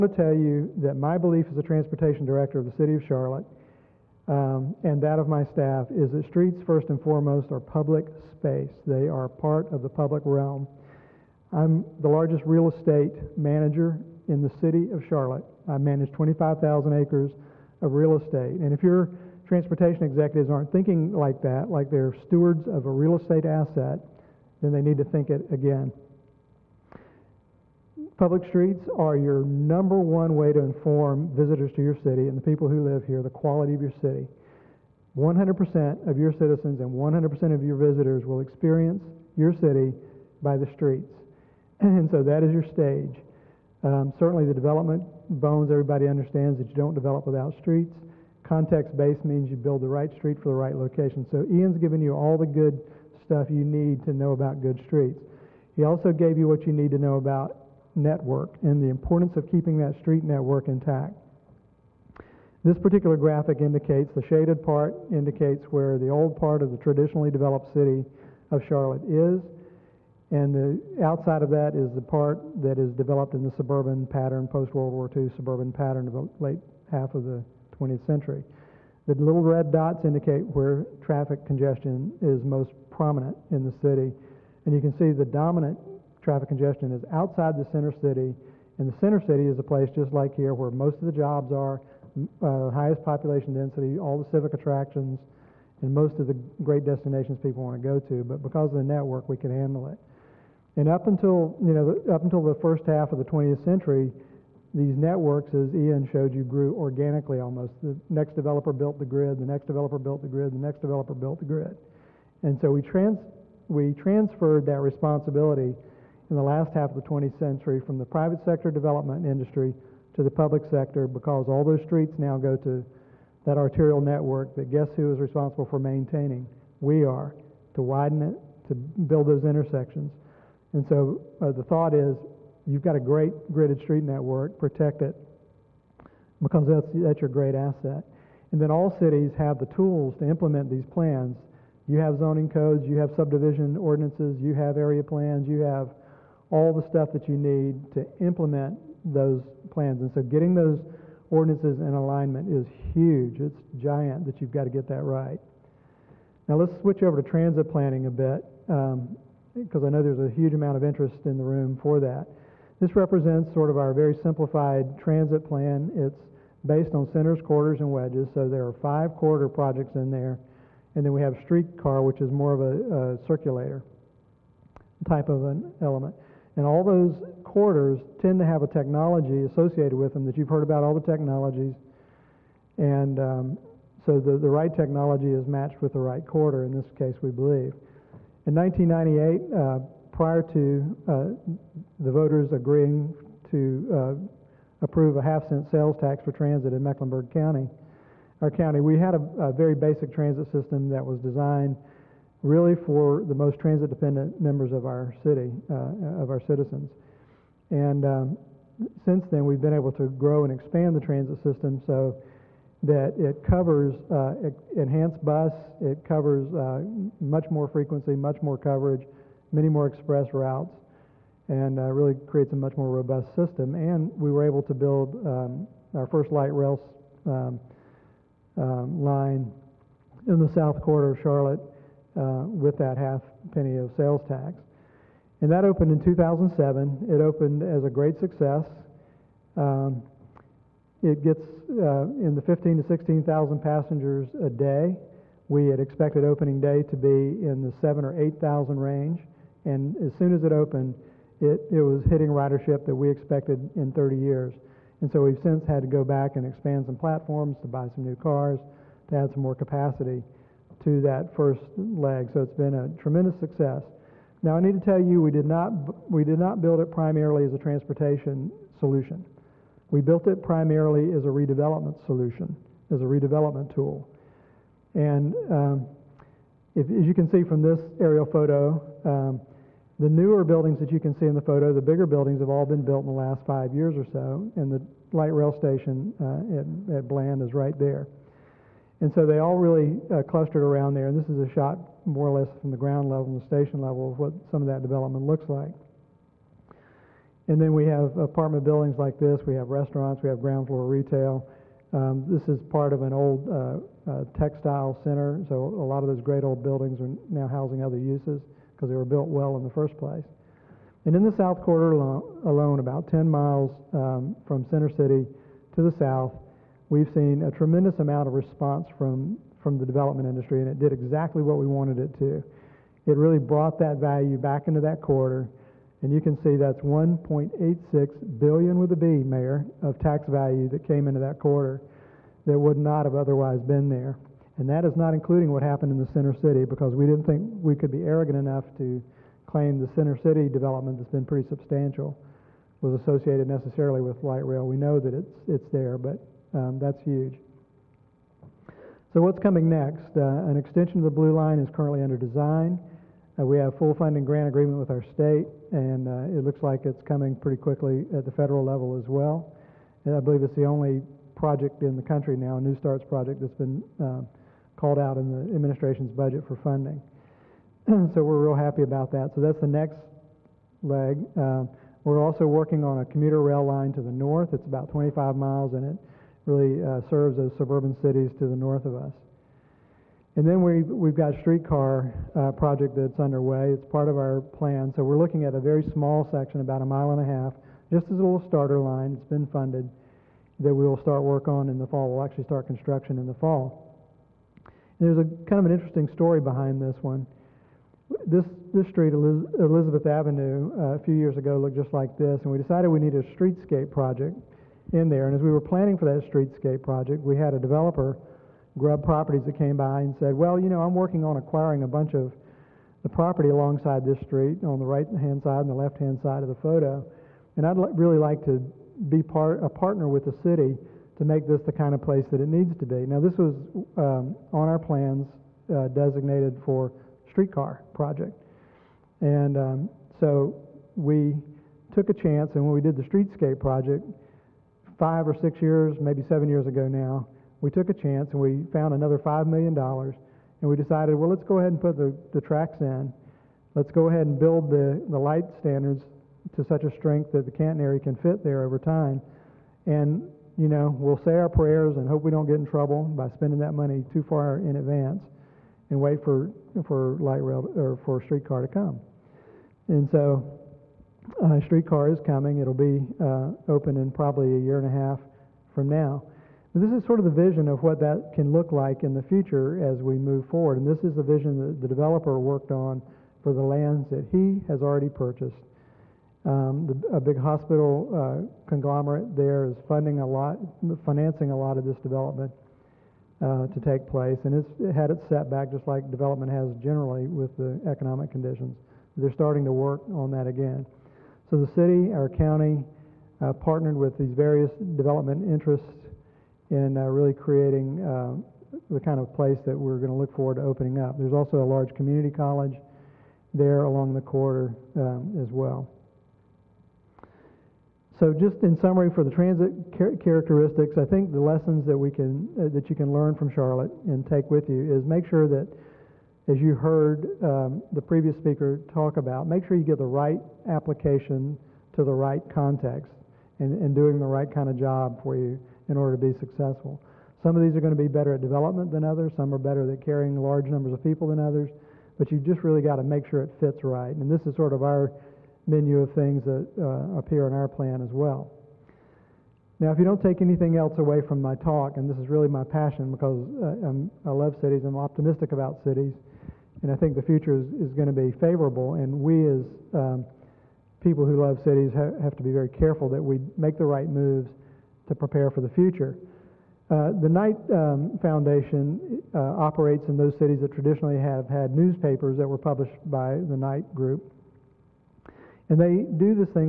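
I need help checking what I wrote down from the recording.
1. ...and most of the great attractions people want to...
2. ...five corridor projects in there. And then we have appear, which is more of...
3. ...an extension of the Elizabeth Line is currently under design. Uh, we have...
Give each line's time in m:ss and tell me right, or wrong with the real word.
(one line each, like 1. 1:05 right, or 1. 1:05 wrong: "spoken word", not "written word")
1. 1:35 wrong: "destinations", not "attractions"
2. 2:48 wrong: "streetcar", not "appear"
3. 5:50 wrong: "Blue", not "Elizabeth".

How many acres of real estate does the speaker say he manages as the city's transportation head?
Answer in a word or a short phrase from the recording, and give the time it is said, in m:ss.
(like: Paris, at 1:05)
25,000, at 0:16.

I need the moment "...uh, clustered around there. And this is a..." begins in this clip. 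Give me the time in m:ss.
4:50.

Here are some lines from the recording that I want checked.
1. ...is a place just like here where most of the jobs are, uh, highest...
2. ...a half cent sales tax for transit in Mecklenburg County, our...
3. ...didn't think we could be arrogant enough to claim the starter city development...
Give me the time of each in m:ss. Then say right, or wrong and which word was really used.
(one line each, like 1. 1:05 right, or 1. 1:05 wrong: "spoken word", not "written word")
1. 1:29 right
2. 3:15 right
3. 5:37 wrong: "center", not "starter".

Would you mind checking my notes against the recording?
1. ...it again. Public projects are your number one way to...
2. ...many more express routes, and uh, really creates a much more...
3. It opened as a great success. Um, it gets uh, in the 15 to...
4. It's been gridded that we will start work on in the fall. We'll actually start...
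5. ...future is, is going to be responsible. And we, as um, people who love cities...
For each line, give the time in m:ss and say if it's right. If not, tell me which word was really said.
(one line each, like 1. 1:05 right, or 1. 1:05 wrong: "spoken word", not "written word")
1. 0:25 wrong: "streets", not "projects"
2. 3:39 right
3. 3:57 right
4. 6:29 wrong: "funded", not "gridded"
5. 9:07 wrong: "favorable", not "responsible".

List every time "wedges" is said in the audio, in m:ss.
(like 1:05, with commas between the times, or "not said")
2:47.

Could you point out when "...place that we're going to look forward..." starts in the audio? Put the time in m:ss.
8:19.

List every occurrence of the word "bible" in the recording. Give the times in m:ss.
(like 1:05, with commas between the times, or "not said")
not said.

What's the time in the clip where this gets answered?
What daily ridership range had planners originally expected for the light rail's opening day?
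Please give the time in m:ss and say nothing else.
4:07.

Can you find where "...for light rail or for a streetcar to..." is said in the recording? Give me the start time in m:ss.
7:36.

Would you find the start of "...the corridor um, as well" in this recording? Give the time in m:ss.
8:24.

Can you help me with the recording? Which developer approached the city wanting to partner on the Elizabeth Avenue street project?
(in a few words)
Grubb Properties.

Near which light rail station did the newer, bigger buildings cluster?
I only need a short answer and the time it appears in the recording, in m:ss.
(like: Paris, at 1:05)
Bland, at 4:47.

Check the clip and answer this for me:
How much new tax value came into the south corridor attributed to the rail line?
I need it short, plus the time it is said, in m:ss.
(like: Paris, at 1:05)
1.86 billion, at 5:26.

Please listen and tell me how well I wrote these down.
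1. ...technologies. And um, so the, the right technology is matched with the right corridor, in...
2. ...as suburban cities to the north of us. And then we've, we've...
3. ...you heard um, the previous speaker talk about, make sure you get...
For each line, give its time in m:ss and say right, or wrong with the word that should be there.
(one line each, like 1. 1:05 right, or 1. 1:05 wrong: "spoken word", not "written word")
1. 3:01 right
2. 6:17 right
3. 8:36 right.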